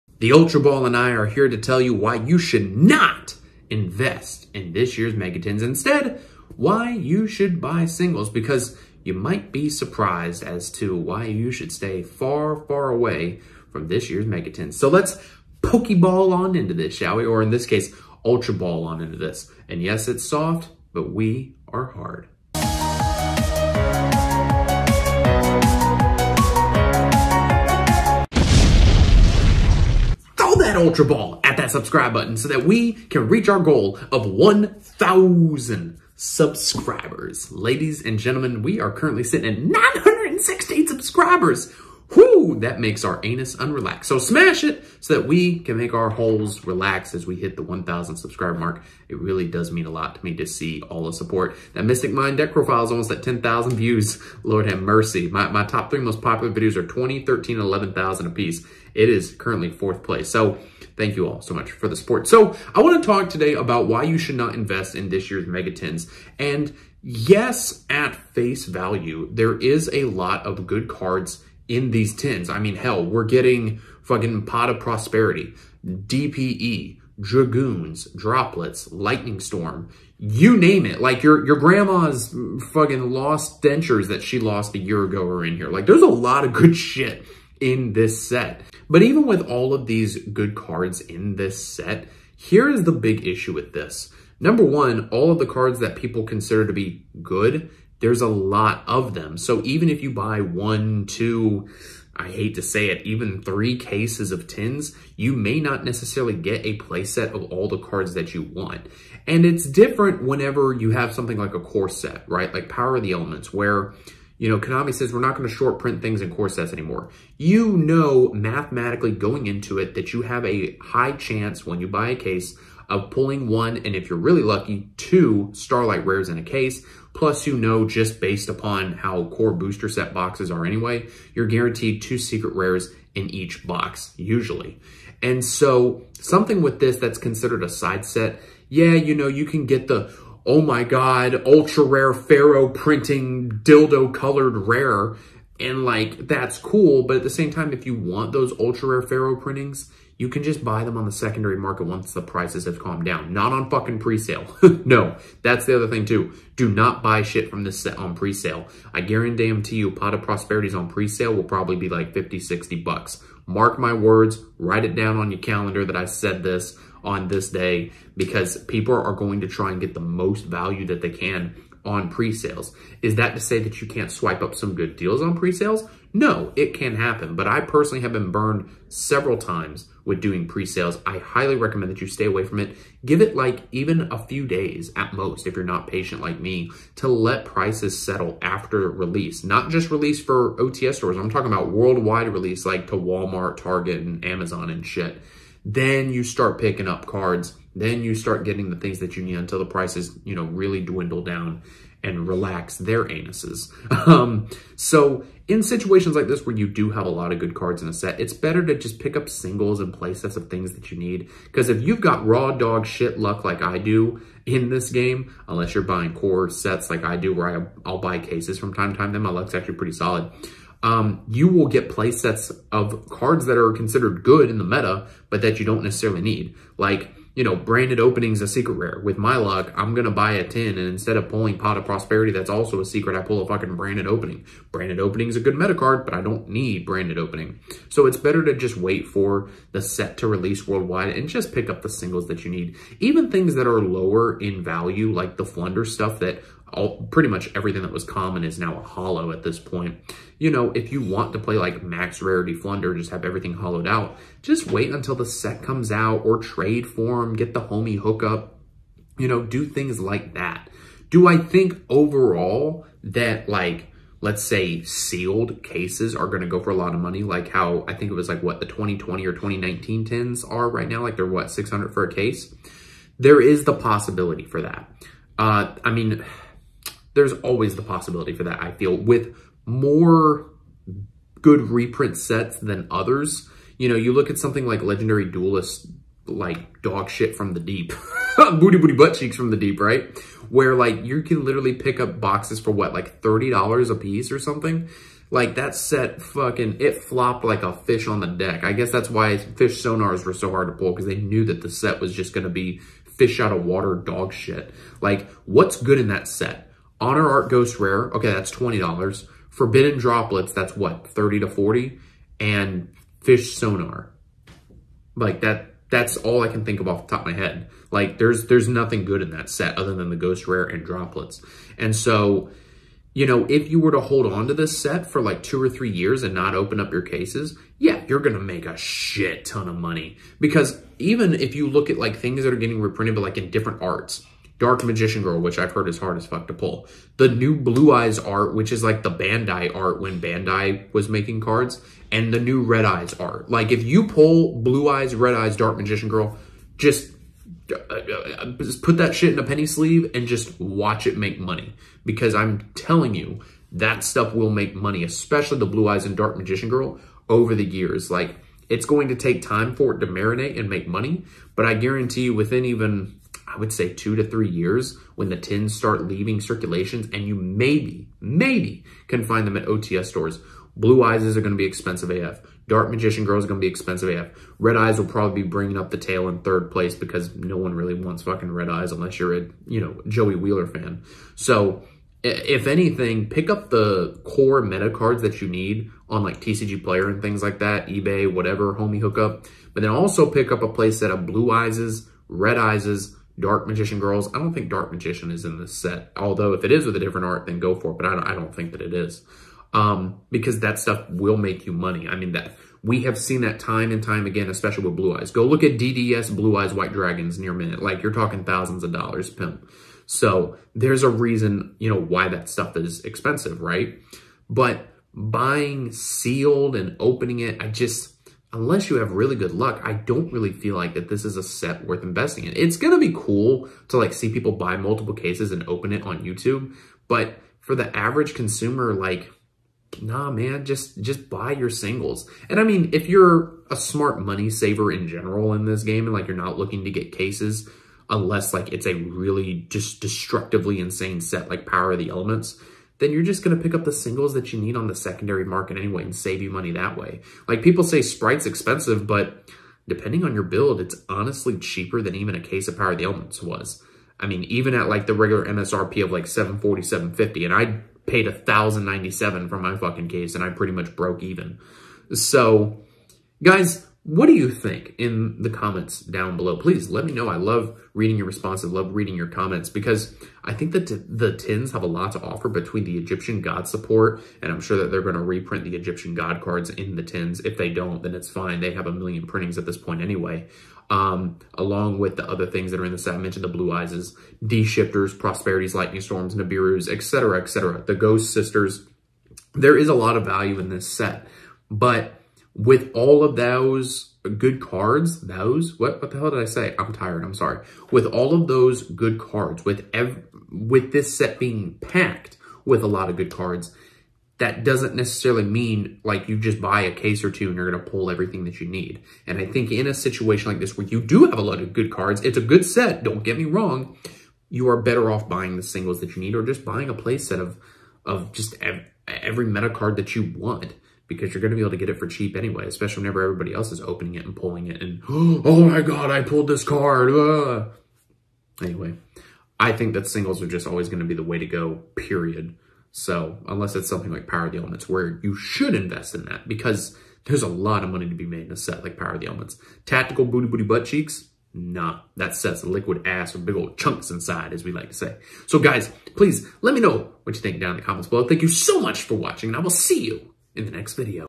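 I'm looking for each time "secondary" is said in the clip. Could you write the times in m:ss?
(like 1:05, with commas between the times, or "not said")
2:31, 7:24.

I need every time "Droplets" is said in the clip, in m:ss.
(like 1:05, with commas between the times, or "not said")
1:18, 5:09, 5:20.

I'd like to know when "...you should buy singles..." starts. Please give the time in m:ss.
0:06.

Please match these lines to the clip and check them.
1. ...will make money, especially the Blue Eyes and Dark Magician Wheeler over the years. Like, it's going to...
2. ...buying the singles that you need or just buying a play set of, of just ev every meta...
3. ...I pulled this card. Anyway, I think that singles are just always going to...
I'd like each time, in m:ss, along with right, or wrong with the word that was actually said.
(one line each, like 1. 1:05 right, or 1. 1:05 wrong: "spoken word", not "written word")
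1. 5:54 wrong: "Girl", not "Wheeler"
2. 8:35 right
3. 8:46 right.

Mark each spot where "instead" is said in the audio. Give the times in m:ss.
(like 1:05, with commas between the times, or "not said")
0:05, 3:50.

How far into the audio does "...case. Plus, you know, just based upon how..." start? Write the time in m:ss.
2:06.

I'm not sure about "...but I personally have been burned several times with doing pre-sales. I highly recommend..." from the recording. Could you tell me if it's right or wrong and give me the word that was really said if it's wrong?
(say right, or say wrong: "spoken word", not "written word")
right.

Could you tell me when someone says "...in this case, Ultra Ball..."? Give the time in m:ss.
0:17.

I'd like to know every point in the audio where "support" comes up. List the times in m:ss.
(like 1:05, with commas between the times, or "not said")
0:51, 1:01, 7:53.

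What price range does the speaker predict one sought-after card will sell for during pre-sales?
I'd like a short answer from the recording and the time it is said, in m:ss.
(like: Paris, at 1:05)
50 to 60 dollars, at 2:42.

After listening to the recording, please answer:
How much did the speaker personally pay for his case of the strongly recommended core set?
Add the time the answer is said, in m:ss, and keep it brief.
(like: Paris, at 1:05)
1097, at 7:38.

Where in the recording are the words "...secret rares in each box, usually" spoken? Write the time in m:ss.
2:12.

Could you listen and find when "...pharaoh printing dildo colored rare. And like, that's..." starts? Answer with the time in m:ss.
2:22.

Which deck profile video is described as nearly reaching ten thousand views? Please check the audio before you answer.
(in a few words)
Mystic Mine.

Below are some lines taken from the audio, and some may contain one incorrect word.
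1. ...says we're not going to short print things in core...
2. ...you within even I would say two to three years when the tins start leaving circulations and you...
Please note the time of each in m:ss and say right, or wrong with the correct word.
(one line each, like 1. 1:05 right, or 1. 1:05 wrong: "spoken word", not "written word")
1. 1:54 right
2. 6:02 right.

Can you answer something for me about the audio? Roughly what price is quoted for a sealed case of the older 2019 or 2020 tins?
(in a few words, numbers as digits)
600.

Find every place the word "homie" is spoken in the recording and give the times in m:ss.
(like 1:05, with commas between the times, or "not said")
4:17, 6:28.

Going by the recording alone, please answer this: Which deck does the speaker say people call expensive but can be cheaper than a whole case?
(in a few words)
Spright.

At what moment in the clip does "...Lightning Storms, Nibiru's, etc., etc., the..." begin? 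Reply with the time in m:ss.
8:05.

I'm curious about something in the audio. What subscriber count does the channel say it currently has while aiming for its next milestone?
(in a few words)
916.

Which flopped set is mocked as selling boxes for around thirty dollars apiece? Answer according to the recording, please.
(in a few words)
Legendary Duelist.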